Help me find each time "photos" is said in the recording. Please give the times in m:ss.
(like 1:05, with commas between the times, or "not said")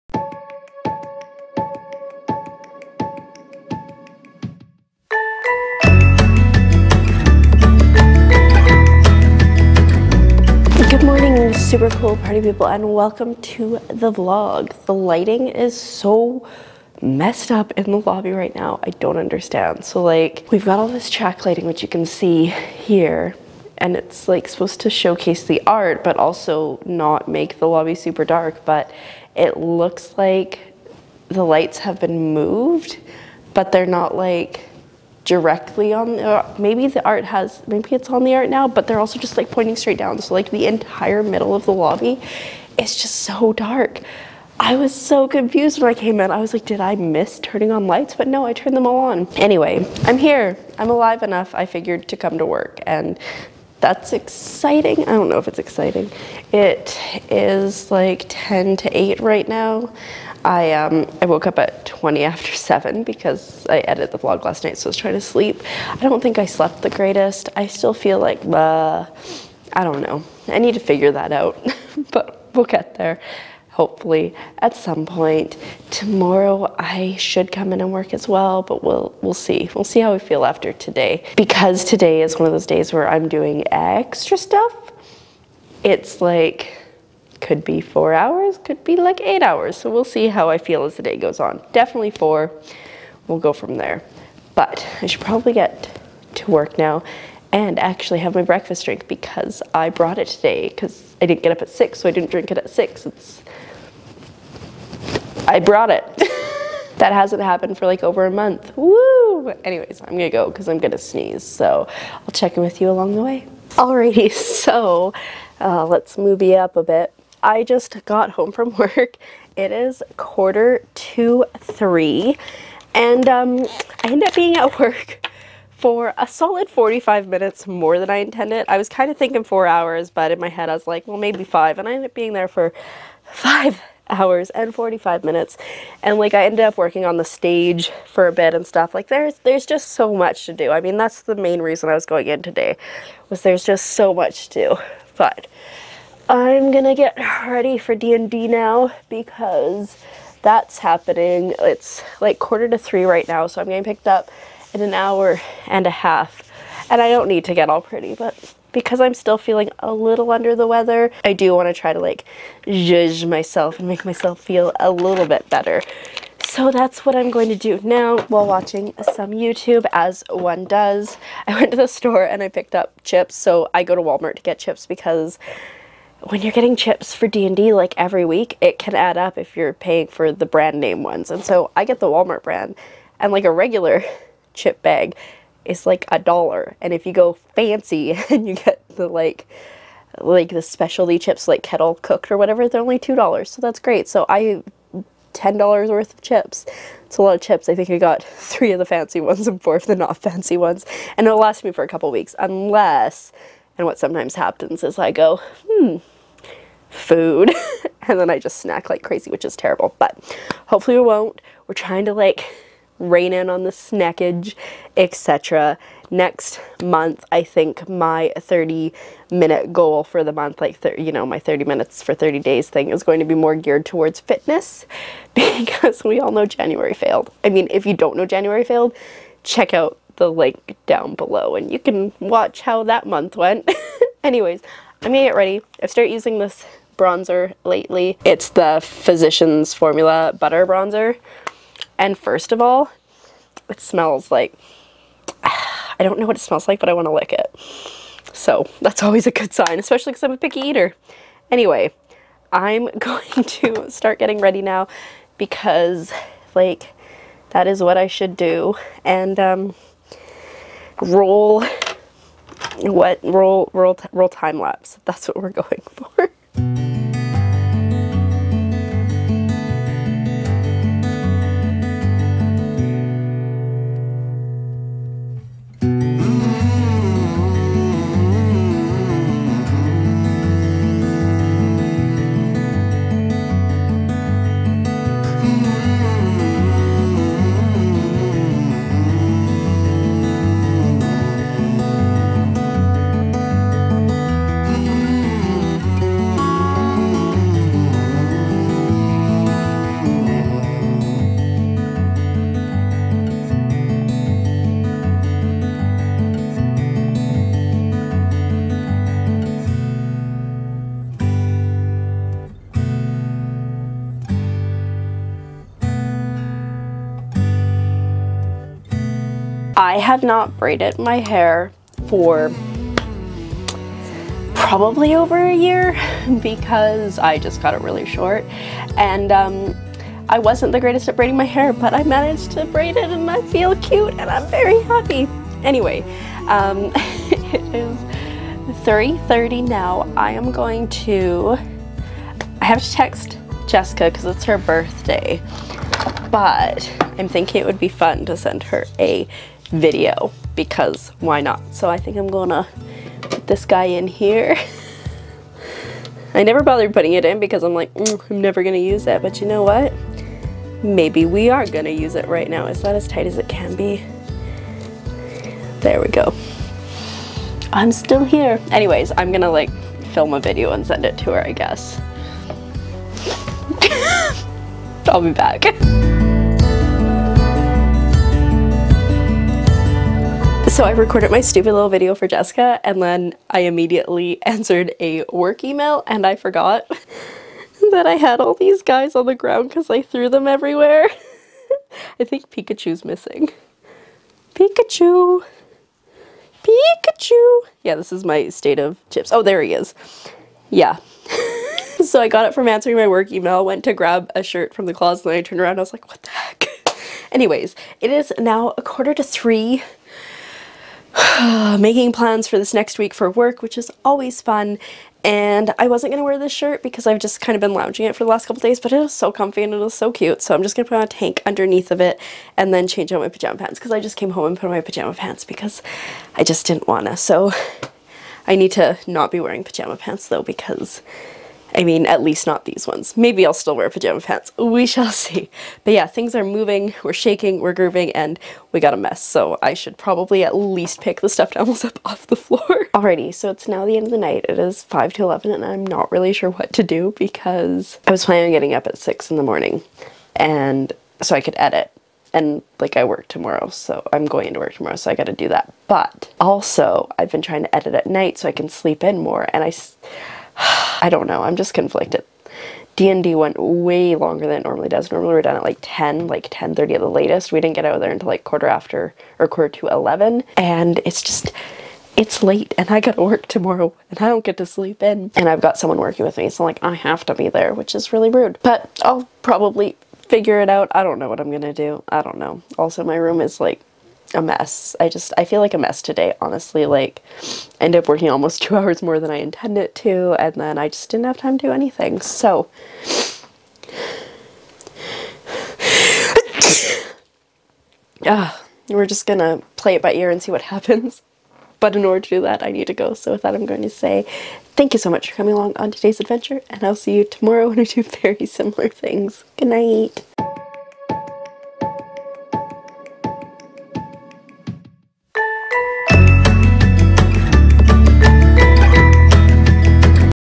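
not said.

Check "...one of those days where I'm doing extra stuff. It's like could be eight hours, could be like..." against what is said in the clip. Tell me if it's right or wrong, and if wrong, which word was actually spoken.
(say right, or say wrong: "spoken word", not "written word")
wrong: "four", not "eight".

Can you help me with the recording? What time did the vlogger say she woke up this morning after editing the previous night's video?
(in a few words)
7:20.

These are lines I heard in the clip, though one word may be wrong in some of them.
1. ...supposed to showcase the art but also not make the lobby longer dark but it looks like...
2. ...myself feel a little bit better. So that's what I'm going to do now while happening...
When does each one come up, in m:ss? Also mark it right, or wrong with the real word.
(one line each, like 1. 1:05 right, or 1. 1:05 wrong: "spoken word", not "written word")
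1. 0:24 wrong: "super", not "longer"
2. 2:44 wrong: "watching", not "happening".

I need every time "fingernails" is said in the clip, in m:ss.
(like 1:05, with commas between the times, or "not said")
not said.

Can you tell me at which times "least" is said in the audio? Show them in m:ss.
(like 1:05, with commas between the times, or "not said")
7:12, 7:20.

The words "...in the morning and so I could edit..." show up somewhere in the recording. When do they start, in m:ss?
7:29.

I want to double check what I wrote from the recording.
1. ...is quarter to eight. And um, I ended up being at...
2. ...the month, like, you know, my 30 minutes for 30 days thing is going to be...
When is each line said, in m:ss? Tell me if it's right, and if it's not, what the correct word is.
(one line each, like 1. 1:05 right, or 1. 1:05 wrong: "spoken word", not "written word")
1. 1:59 wrong: "three", not "eight"
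2. 3:40 right.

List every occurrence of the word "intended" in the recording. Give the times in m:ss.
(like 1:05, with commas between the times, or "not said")
2:08, 8:09.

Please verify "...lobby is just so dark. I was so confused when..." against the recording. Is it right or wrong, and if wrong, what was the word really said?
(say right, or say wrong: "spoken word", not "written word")
right.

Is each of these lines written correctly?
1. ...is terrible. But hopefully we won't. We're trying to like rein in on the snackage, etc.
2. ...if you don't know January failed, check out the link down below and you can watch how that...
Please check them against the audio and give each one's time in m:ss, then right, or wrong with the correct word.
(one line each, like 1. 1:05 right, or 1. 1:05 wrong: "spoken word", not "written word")
1. 3:29 right
2. 3:47 right.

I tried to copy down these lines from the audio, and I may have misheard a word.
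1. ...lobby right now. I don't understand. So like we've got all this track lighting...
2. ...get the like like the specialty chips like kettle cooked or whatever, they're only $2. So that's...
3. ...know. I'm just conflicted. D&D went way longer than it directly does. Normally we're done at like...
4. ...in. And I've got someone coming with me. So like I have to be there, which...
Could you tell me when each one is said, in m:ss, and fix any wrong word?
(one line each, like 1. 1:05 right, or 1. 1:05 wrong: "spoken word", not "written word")
1. 0:18 right
2. 3:08 right
3. 7:41 wrong: "normally", not "directly"
4. 7:55 wrong: "working", not "coming".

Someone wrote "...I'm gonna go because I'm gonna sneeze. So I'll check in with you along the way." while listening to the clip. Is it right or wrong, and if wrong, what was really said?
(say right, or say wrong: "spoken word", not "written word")
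right.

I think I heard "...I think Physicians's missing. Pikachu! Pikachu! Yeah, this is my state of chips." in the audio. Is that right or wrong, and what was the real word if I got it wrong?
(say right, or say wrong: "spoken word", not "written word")
wrong: "Pikachu", not "Physicians".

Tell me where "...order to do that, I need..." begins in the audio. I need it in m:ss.
8:22.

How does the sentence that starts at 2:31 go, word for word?
It's like quarter to three right now, so I'm getting picked up in an hour and a half.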